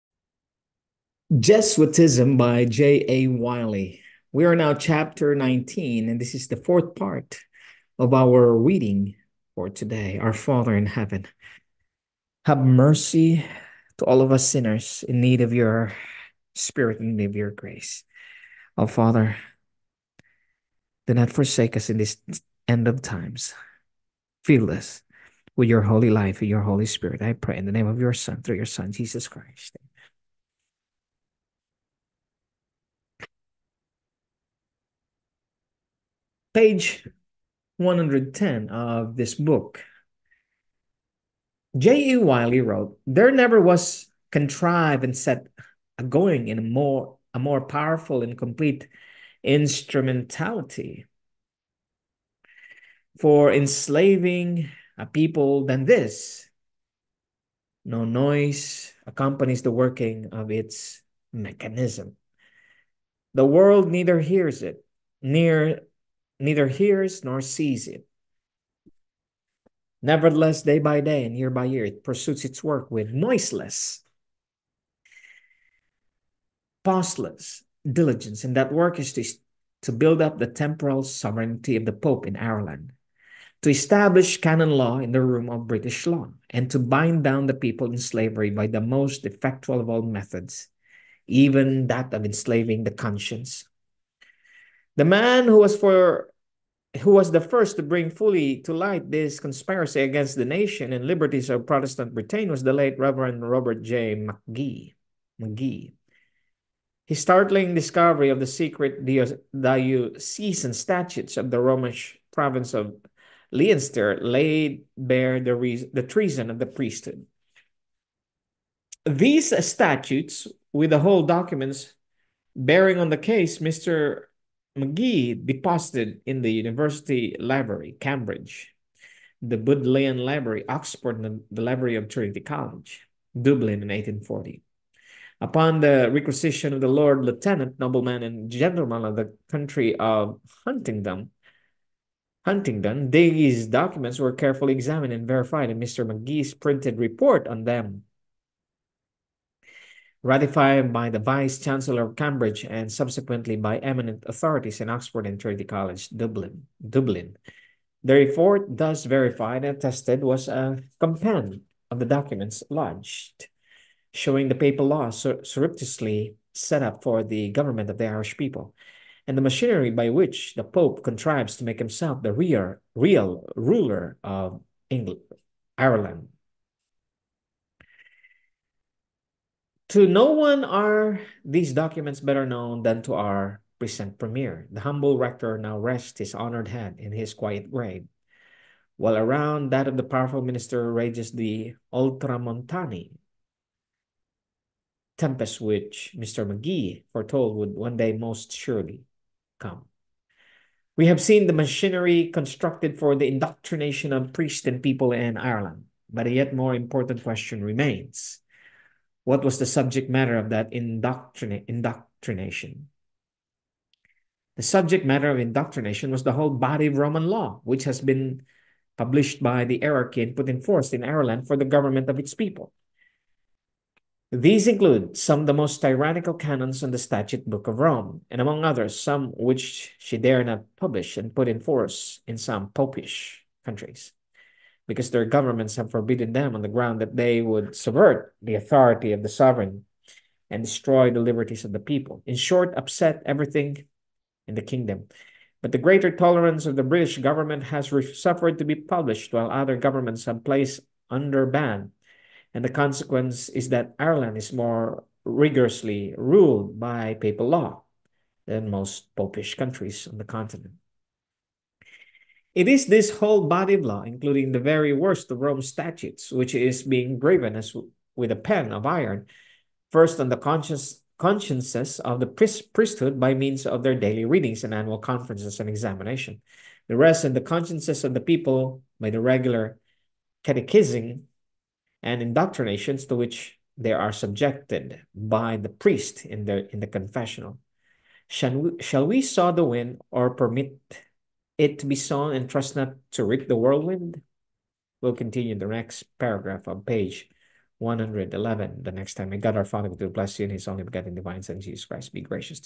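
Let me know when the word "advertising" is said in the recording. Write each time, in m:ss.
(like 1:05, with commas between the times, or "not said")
not said.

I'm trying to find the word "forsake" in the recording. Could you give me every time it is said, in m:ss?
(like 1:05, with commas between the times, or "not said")
0:21.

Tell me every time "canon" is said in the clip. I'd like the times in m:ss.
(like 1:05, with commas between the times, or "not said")
1:24, 3:46.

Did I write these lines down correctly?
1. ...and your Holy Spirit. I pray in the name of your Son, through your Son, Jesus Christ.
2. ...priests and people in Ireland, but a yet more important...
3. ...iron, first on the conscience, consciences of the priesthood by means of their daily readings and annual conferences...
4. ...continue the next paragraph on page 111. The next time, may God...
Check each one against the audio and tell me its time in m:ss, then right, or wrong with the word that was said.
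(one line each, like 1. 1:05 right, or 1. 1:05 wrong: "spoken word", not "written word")
1. 0:26 right
2. 3:24 right
3. 4:28 right
4. 4:55 right.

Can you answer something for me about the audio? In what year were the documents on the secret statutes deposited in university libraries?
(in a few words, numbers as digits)
1840.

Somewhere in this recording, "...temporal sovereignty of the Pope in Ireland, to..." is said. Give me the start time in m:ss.
1:20.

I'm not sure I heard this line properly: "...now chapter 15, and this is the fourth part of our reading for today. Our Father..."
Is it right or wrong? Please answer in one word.
wrong.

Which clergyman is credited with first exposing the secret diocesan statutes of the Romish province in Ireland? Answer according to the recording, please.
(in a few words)
Robert J. McGee.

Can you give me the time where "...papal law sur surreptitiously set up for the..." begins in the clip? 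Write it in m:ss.
2:44.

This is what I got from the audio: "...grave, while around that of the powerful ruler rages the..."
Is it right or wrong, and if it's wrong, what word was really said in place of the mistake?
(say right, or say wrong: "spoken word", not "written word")
wrong: "minister", not "ruler".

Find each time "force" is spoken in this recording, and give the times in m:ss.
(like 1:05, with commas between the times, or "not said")
3:40, 3:51.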